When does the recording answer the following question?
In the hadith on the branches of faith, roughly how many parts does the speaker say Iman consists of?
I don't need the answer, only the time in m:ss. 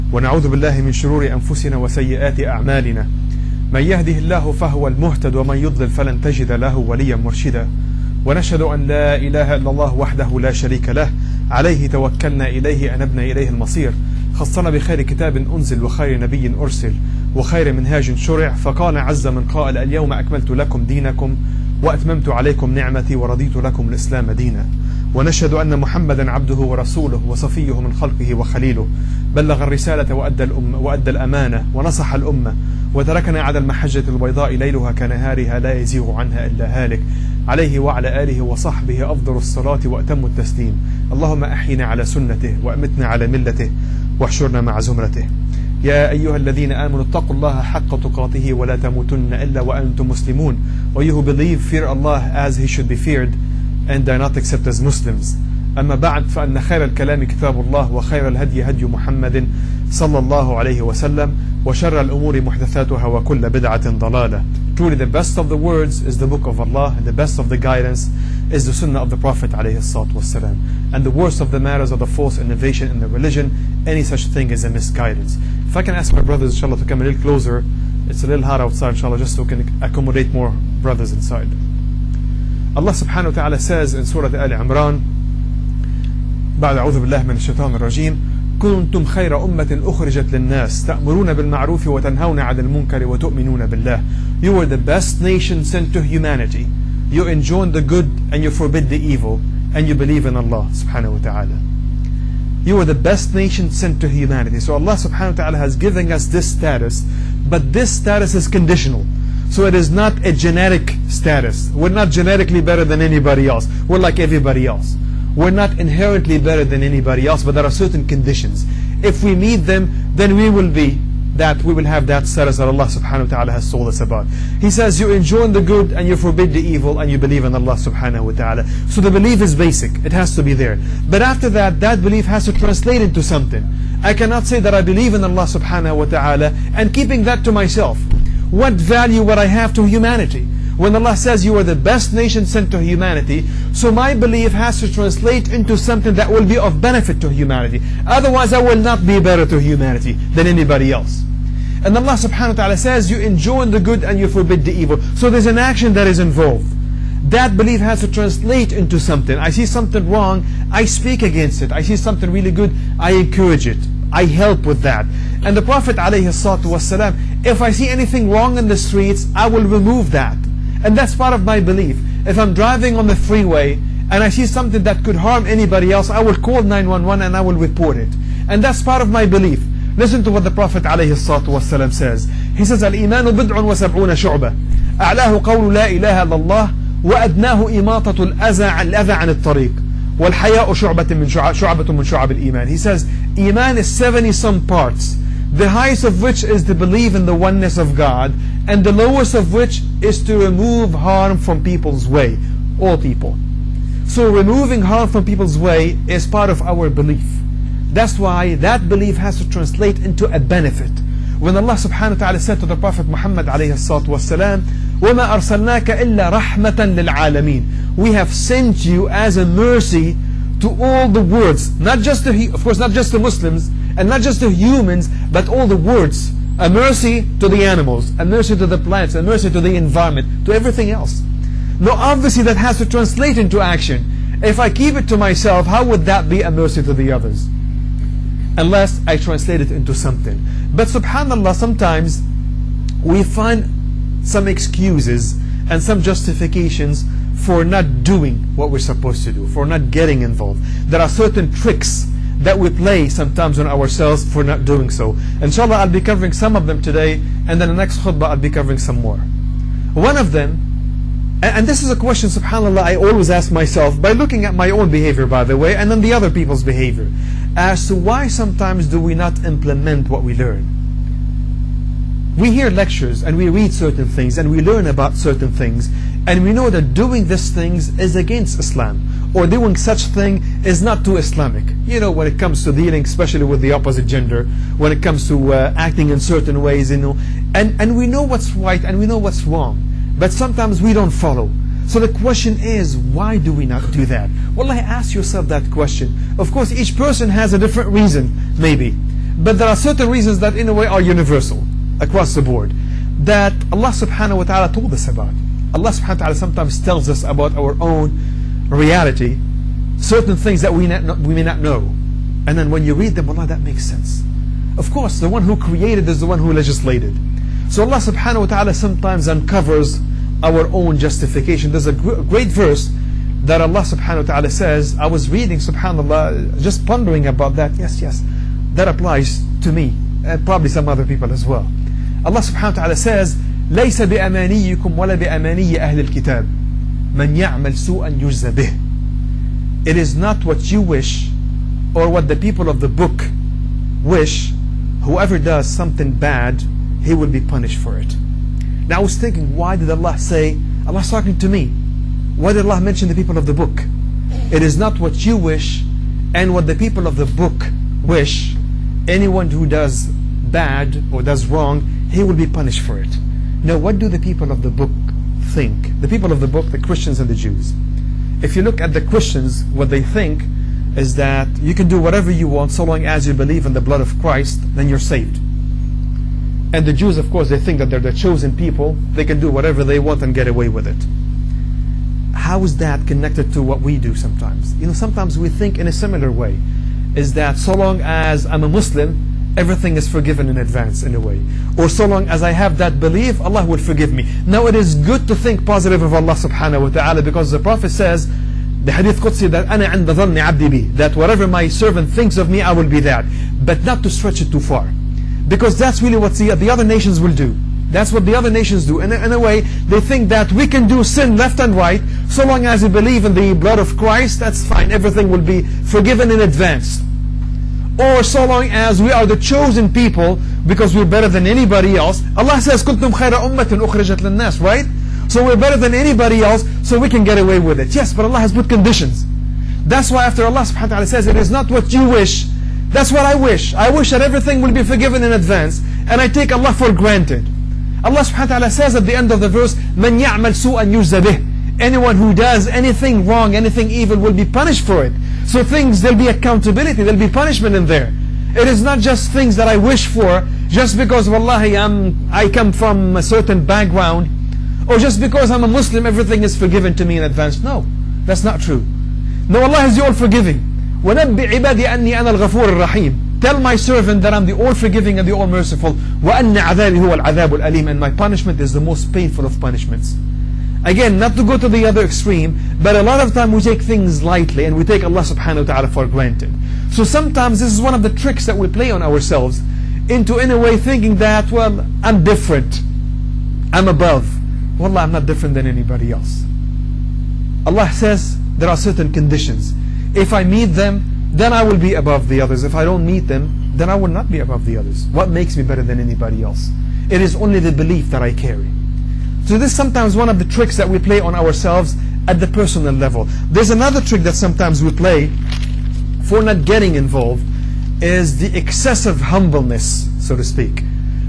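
3:13.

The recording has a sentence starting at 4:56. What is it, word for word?
Of course, each person has a different reason, maybe.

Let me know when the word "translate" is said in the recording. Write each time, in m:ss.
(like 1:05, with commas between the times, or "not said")
2:12, 2:24, 2:38, 3:29, 3:52, 3:59.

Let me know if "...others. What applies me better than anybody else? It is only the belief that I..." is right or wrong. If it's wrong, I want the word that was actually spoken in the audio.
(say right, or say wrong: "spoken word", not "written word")
wrong: "makes", not "applies".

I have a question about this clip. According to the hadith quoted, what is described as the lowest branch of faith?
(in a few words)
remove harm from people's way.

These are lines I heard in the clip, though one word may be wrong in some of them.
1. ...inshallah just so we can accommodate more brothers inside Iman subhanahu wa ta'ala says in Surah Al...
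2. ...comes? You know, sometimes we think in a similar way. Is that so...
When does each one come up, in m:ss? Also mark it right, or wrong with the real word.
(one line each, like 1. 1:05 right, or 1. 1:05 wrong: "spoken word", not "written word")
1. 1:18 wrong: "Allah", not "Iman"
2. 6:24 wrong: "sometimes", not "comes".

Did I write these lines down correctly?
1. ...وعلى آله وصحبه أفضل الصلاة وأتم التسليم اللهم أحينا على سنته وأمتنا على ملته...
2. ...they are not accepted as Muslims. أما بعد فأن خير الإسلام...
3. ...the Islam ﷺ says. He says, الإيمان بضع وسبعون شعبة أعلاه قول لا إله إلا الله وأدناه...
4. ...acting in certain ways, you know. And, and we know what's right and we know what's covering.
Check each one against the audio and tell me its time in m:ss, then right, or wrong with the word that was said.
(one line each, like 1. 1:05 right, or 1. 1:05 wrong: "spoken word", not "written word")
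1. 0:37 right
2. 0:54 wrong: "الكلام", not "الإسلام"
3. 3:00 wrong: "Prophet", not "Islam"
4. 4:45 wrong: "wrong", not "covering".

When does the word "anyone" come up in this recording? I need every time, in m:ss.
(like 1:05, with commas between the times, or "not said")
5:59, 7:21.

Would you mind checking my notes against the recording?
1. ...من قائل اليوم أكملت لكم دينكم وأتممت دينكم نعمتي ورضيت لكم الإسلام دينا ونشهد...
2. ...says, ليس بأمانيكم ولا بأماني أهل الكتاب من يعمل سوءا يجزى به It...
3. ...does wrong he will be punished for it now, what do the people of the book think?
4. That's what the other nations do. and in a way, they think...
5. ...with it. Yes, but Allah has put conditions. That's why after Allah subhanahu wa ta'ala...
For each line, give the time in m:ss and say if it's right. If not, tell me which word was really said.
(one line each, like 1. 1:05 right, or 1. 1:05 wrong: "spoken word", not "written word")
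1. 0:19 wrong: "عليكم", not "دينكم"
2. 5:32 right
3. 6:01 right
4. 6:47 right
5. 7:07 right.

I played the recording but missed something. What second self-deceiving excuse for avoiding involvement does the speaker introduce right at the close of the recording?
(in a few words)
excessive humbleness.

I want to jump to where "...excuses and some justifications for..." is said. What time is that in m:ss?
4:04.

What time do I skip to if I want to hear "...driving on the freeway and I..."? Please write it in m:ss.
2:52.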